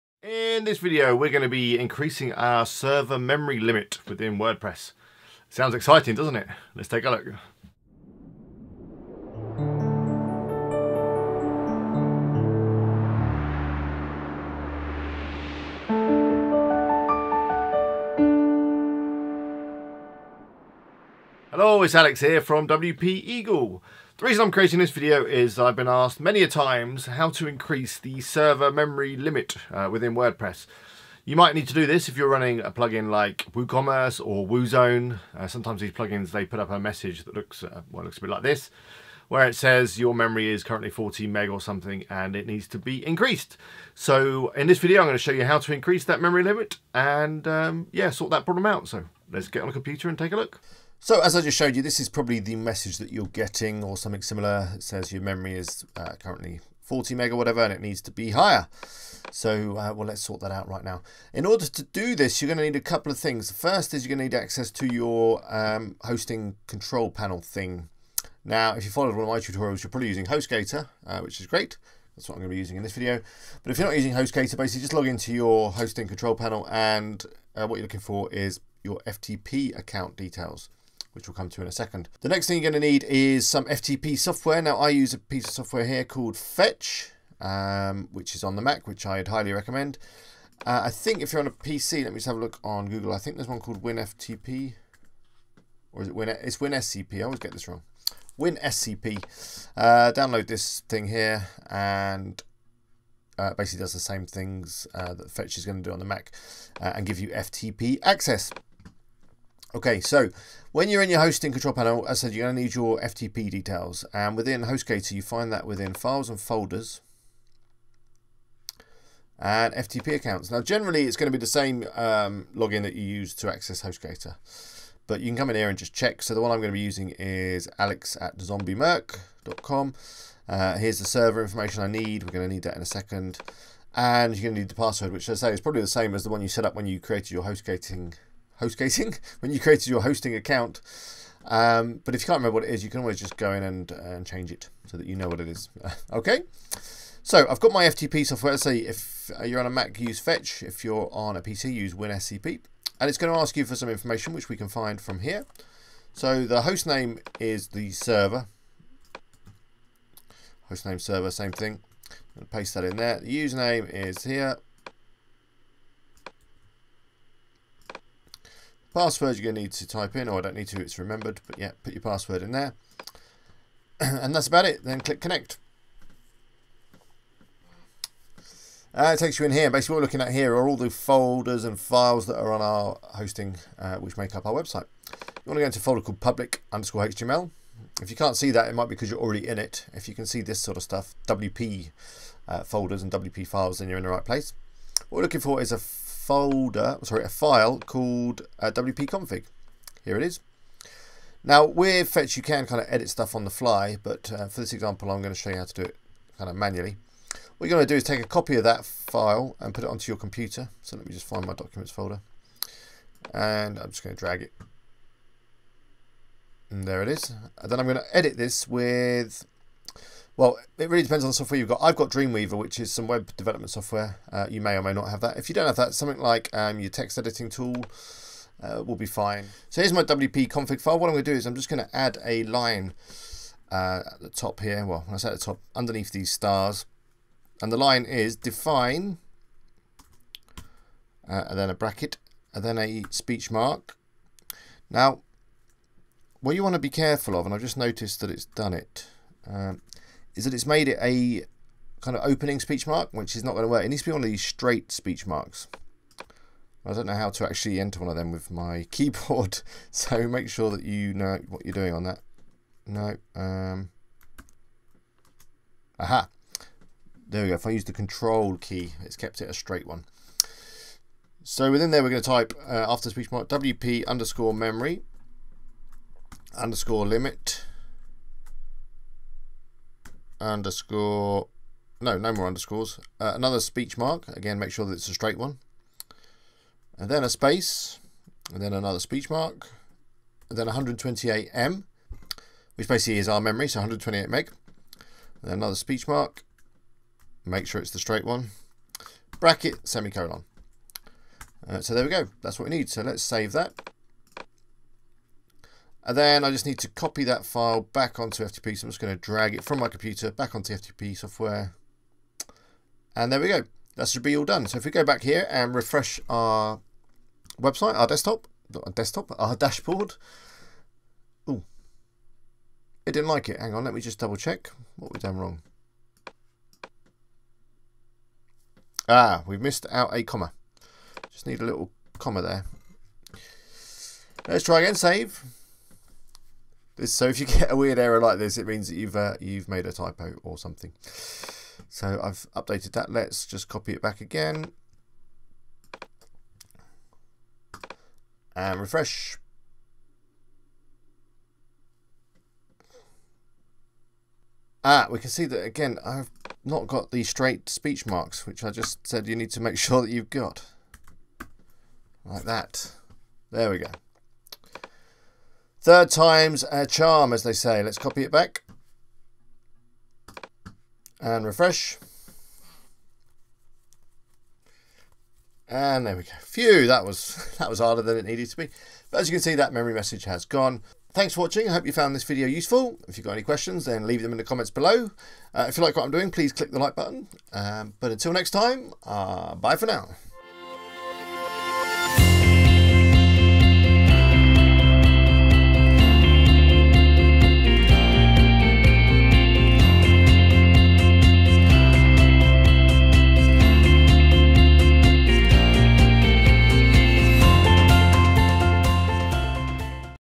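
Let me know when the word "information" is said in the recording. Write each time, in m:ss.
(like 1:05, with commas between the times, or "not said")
2:11, 2:33.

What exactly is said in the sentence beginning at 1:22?
The next thing you're going to need is some FTP software.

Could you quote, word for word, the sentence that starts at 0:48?
So let's get on a computer and take a look.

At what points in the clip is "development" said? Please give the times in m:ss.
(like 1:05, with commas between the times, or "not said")
3:43.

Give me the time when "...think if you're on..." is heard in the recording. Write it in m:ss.
1:30.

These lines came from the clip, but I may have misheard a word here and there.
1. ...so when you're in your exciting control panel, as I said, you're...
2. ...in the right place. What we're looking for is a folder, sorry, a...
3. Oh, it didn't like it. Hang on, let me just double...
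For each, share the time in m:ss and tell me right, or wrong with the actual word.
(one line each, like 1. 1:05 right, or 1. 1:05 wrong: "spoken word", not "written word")
1. 1:50 wrong: "hosting", not "exciting"
2. 3:13 right
3. 5:21 right.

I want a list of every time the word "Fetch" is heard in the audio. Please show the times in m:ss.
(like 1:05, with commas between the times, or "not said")
1:26, 1:45, 2:30, 3:22.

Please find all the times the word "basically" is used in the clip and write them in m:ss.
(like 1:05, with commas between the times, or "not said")
1:14, 1:43, 2:59, 4:52.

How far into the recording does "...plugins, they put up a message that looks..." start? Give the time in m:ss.
0:35.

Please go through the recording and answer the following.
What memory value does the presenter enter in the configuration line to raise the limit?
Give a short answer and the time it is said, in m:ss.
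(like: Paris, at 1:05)
128M, at 4:50.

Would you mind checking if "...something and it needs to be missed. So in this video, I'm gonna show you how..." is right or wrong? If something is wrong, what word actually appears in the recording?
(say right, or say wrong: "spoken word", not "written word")
wrong: "increased", not "missed".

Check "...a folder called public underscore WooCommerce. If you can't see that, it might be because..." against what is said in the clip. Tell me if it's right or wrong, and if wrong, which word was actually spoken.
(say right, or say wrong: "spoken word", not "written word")
wrong: "HTML", not "WooCommerce".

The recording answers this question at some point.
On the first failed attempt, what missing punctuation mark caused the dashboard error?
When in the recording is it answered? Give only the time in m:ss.
5:30.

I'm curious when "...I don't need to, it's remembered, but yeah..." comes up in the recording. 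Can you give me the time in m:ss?
2:50.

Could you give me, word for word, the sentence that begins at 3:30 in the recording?
So let me just find my documents folder.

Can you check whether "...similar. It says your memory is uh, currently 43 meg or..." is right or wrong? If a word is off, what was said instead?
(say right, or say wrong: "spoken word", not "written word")
wrong: "40", not "43".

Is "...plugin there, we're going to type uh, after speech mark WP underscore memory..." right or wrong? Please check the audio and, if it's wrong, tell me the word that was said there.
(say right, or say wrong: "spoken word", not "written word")
wrong: "within", not "plugin".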